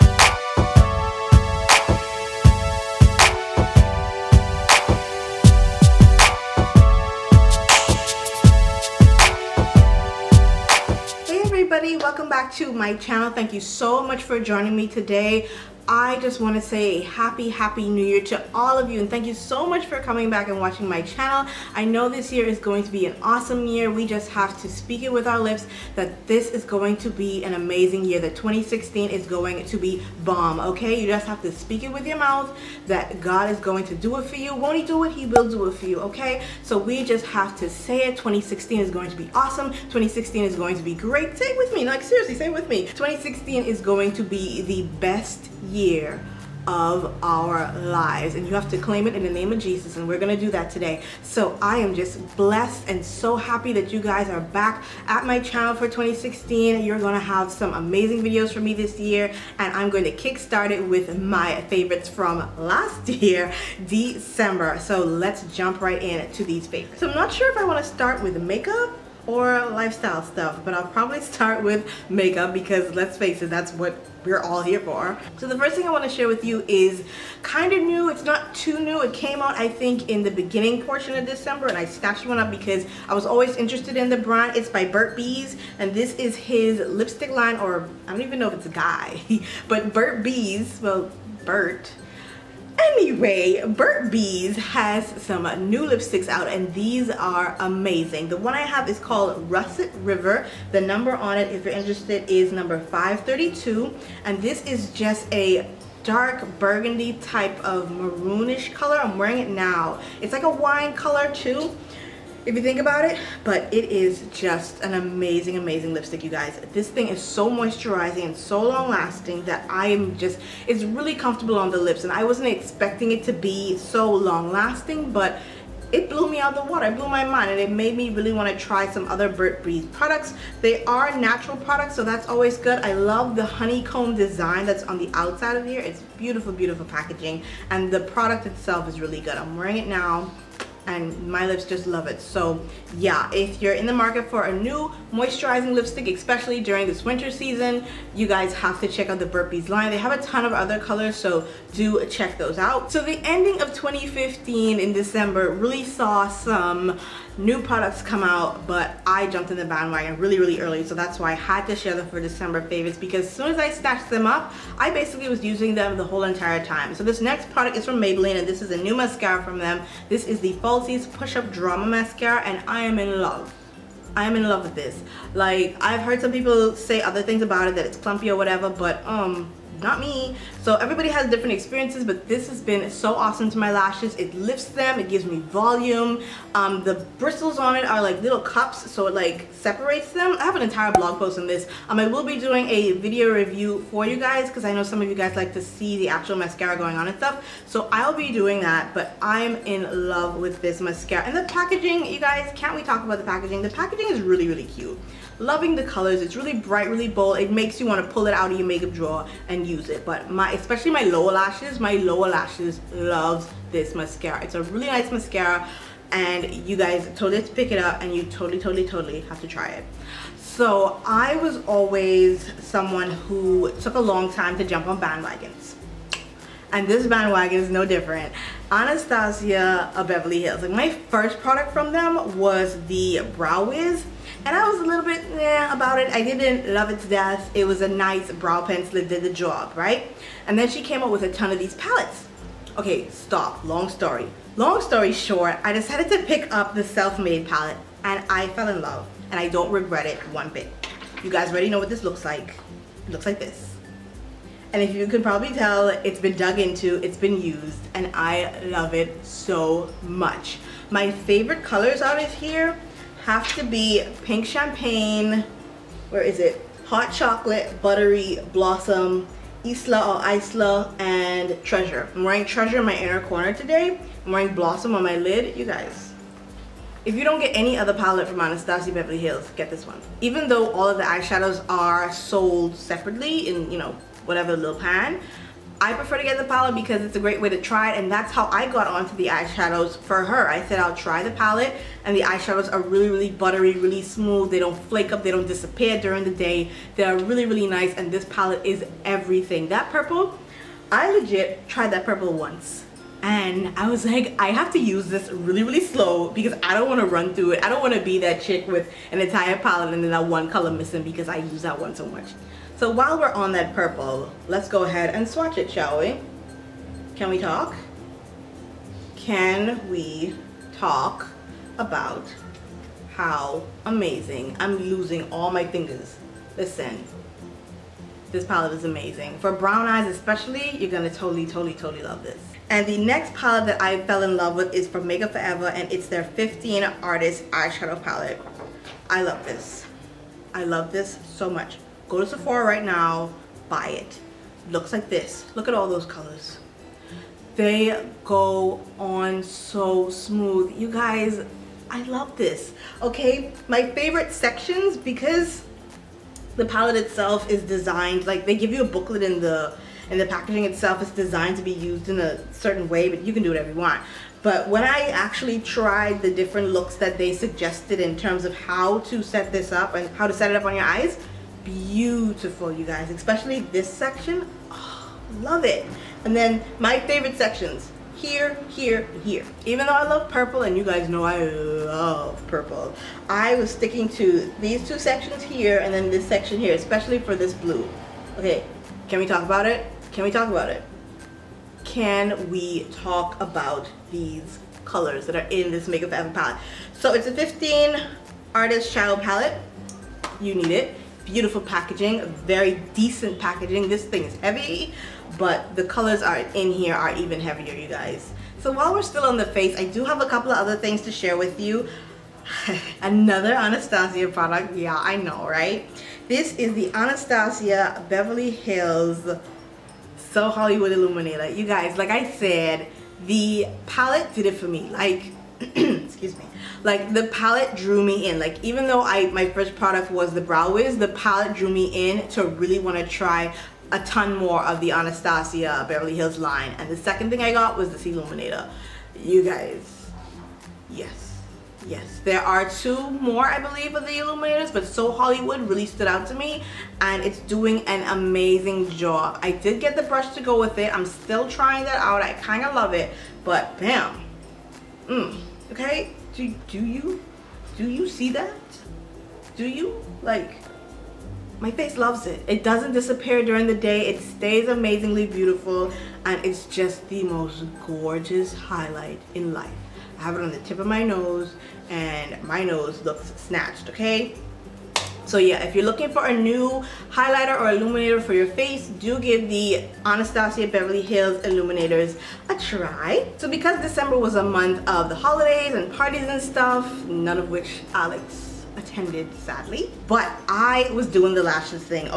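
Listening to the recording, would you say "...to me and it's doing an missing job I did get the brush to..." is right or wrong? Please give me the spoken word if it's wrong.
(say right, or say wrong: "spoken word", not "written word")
wrong: "amazing", not "missing".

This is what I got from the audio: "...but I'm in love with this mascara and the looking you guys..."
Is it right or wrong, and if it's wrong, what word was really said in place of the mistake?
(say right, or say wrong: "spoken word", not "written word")
wrong: "packaging", not "looking".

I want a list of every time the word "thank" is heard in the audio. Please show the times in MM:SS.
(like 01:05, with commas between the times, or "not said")
00:13, 00:19.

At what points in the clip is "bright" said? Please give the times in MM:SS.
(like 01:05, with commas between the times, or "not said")
03:26.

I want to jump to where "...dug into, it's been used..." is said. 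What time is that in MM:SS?
04:16.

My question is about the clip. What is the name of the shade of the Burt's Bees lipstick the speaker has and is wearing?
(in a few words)
Russet River.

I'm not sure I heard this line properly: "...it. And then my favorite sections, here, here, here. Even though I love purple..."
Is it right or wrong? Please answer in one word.
right.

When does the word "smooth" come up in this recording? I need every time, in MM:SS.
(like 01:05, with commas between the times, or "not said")
04:54, 05:50.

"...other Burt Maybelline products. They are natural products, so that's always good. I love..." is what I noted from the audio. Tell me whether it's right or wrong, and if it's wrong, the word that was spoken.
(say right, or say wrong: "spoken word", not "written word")
wrong: "Bees", not "Maybelline".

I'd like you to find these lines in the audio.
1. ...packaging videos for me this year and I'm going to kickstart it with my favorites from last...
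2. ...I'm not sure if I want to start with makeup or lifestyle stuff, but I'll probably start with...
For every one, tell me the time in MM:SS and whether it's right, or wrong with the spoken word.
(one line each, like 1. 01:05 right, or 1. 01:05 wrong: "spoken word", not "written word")
1. 00:57 wrong: "amazing", not "packaging"
2. 01:07 right.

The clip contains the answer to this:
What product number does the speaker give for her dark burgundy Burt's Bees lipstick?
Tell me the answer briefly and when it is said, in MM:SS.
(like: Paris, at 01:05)
532, at 01:42.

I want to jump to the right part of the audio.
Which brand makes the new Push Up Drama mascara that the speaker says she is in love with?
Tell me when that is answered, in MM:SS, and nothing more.
02:48.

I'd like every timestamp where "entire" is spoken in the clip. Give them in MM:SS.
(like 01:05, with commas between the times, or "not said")
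02:46, 03:10, 05:09.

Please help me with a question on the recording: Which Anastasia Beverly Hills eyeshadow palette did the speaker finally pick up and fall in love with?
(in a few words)
Self-Made.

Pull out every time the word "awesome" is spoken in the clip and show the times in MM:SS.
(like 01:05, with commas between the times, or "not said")
00:23, 00:39, 03:03.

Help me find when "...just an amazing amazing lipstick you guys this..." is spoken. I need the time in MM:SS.
01:54.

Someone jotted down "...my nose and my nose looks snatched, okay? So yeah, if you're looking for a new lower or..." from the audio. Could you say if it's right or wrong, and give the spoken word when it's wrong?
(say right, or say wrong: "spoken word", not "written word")
wrong: "highlighter", not "lower".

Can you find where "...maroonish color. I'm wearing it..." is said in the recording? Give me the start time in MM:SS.
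01:47.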